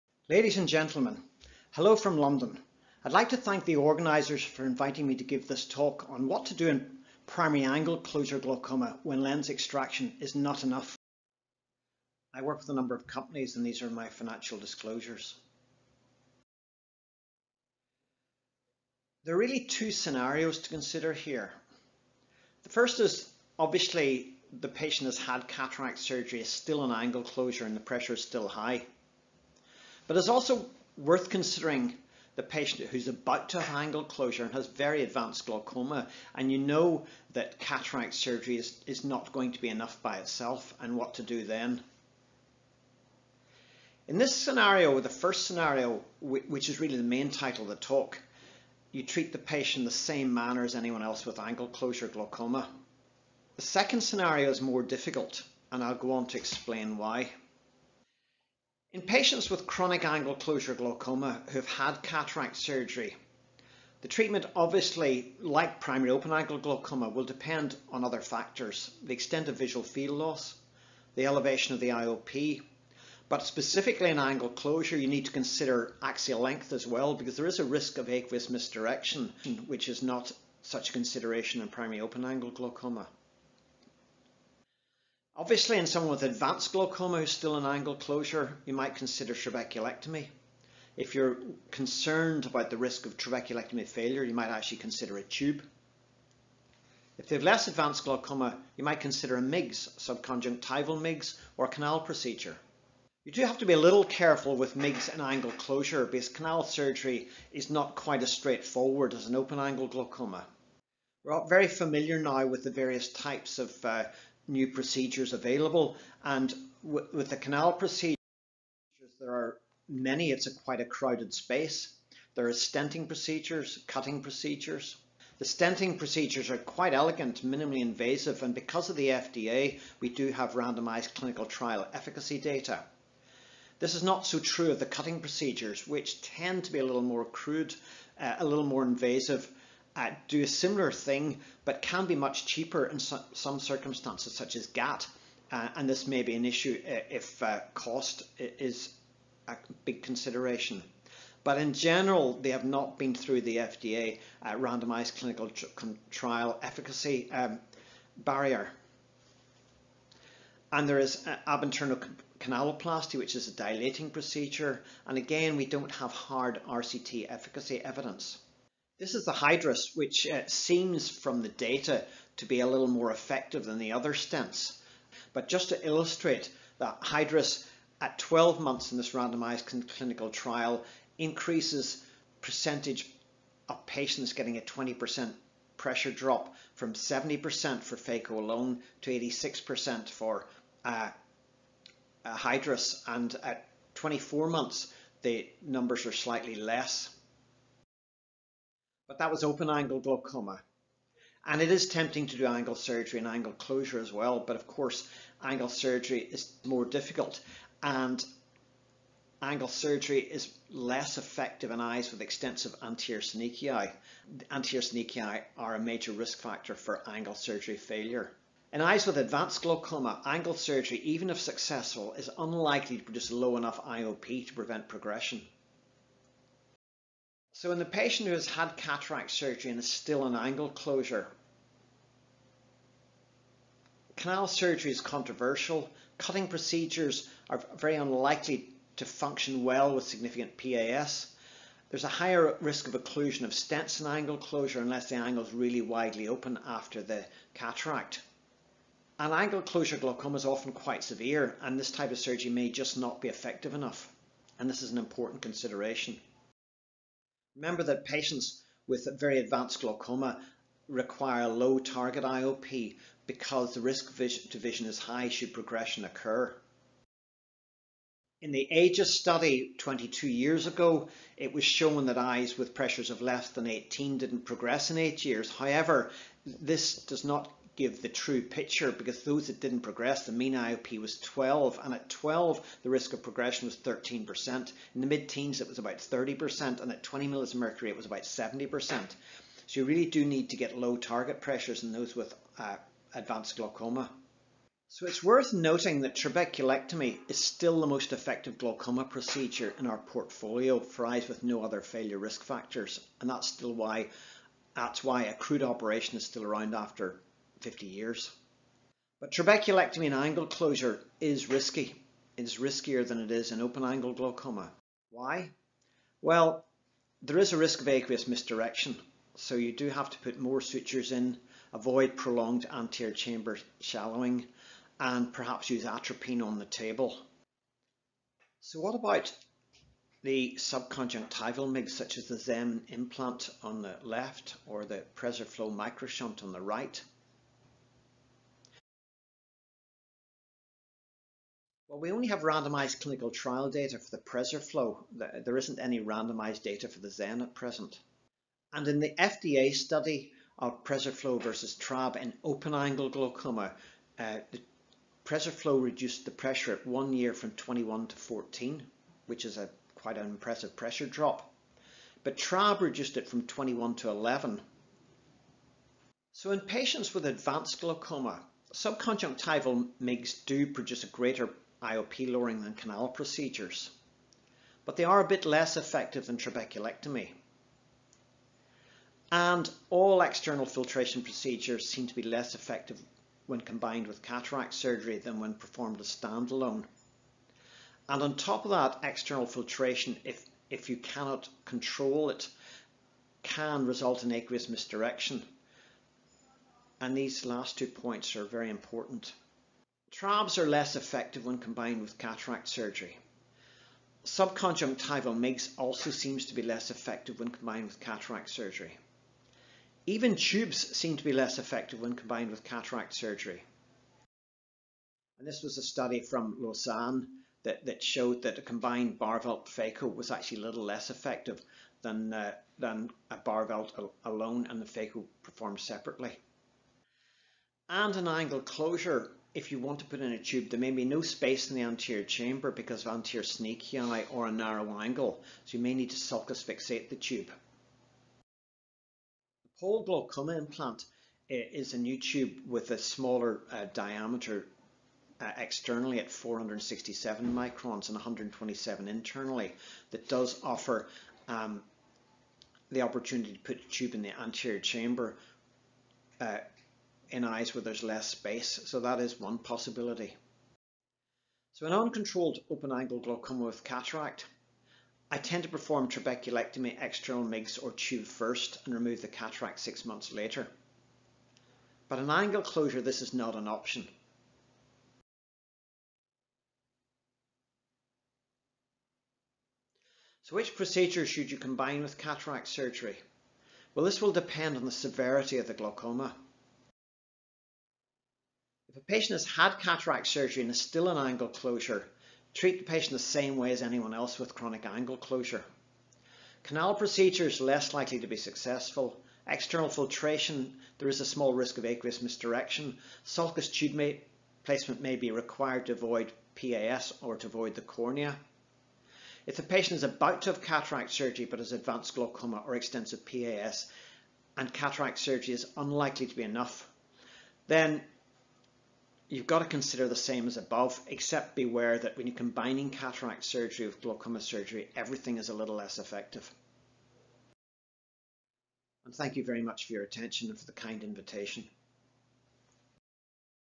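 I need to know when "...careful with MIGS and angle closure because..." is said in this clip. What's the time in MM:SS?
01:44.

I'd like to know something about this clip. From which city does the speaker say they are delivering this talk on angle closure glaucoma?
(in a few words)
London.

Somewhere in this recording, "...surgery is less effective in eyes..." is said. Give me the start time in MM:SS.
03:29.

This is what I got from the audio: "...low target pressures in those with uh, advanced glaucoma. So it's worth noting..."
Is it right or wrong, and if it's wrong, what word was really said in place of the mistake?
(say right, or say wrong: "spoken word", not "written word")
right.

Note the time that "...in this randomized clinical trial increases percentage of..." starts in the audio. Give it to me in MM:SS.
02:58.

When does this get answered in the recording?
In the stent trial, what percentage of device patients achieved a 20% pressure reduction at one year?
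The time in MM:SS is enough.
03:09.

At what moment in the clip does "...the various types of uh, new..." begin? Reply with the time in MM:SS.
01:52.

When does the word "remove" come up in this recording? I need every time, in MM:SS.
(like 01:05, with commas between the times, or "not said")
07:48.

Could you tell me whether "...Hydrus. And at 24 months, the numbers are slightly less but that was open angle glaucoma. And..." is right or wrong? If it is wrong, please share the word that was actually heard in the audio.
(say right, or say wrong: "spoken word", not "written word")
right.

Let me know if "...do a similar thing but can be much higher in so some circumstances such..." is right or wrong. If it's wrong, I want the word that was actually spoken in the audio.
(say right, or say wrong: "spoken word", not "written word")
wrong: "cheaper", not "higher".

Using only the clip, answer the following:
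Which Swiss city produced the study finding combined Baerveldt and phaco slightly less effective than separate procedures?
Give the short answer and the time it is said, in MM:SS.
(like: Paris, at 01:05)
Lausanne, at 06:56.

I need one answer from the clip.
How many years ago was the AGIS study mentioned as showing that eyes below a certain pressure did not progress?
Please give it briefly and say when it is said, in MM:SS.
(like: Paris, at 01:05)
22, at 04:29.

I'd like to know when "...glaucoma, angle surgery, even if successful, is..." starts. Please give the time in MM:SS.
03:39.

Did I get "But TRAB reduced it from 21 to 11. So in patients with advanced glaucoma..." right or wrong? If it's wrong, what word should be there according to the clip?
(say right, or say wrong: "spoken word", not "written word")
right.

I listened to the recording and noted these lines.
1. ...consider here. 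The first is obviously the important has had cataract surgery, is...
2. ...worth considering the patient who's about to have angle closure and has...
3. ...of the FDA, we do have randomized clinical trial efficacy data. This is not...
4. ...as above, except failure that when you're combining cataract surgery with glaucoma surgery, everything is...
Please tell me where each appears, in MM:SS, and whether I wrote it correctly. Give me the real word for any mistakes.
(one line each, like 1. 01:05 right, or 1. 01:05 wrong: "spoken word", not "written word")
1. 00:20 wrong: "patient", not "important"
2. 00:30 right
3. 02:08 right
4. 08:40 wrong: "beware", not "failure".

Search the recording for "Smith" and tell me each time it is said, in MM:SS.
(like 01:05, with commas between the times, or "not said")
not said.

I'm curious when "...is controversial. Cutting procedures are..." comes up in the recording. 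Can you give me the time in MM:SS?
03:54.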